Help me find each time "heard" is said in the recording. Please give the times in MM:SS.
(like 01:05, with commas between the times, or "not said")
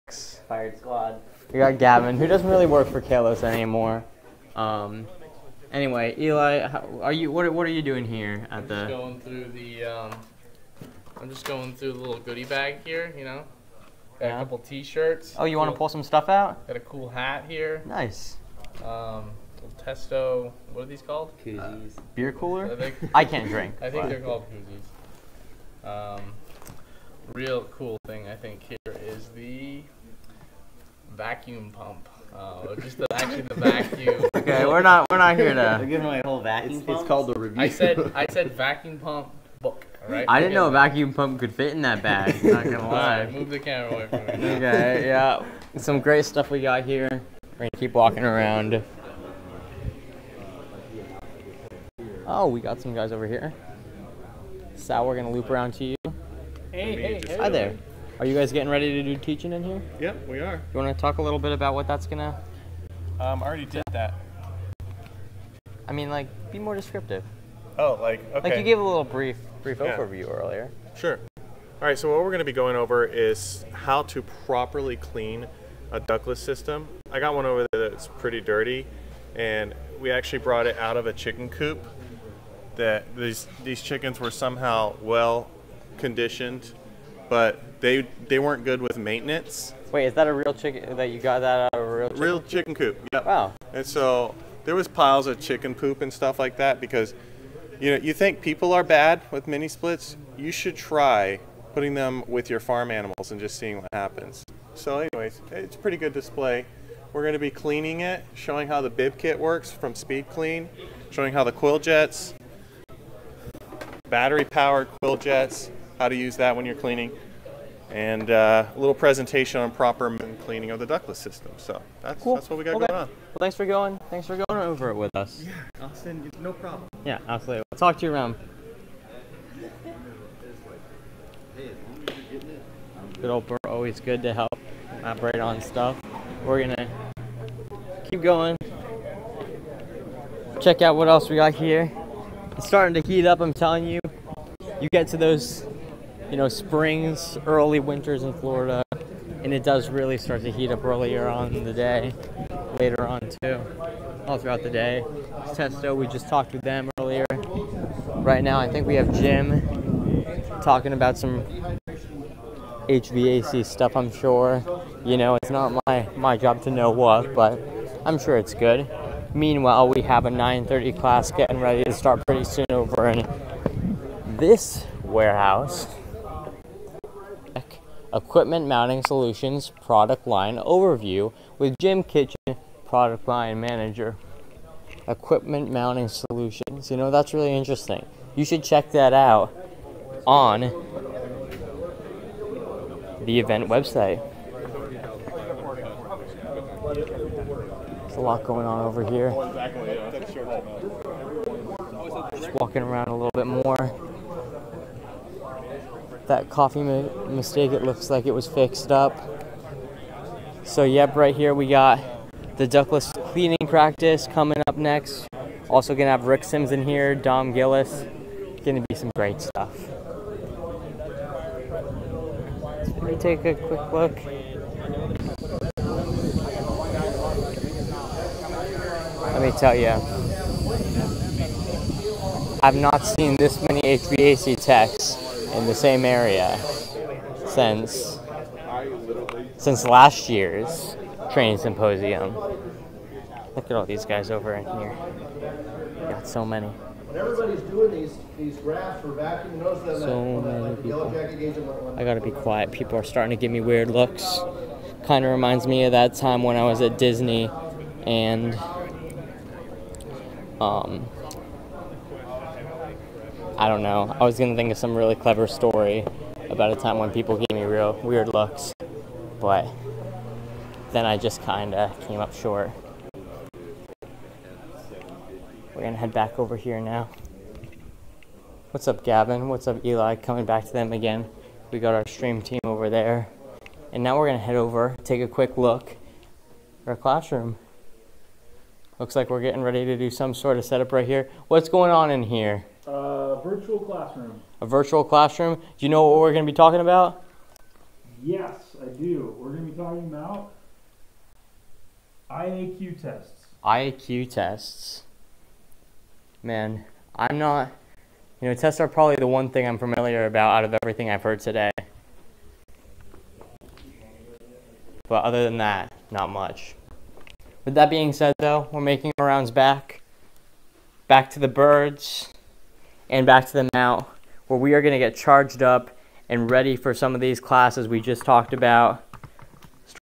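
05:11.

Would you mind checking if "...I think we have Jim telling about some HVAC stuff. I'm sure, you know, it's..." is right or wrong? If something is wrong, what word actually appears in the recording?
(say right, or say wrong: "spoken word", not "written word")
wrong: "talking", not "telling".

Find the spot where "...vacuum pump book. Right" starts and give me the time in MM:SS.
00:38.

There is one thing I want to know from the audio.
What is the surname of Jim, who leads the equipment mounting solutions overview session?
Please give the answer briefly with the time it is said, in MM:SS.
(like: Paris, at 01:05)
Kitchen, at 03:02.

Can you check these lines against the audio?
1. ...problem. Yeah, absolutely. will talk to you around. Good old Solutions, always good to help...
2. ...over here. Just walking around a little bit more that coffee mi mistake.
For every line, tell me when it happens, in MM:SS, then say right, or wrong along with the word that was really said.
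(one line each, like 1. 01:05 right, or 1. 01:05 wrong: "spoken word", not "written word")
1. 02:06 wrong: "Bert", not "Solutions"
2. 03:18 right.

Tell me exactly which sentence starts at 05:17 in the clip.
With that being said, though, we're making our rounds back.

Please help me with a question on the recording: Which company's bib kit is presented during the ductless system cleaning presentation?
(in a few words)
SpeedClean.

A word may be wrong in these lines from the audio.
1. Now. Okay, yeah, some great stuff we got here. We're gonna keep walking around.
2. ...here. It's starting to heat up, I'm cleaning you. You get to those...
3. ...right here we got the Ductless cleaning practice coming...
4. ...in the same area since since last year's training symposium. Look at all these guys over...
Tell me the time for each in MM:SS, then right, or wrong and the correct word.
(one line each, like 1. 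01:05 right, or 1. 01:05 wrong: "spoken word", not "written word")
1. 00:44 right
2. 02:21 wrong: "telling", not "cleaning"
3. 03:31 right
4. 03:55 right.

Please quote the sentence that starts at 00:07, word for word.
What, what are you doing here at I'm the?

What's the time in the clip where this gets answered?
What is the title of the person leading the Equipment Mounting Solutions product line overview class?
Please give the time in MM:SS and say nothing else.
03:02.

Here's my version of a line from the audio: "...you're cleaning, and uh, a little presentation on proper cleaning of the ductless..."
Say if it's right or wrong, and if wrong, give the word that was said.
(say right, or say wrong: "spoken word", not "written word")
right.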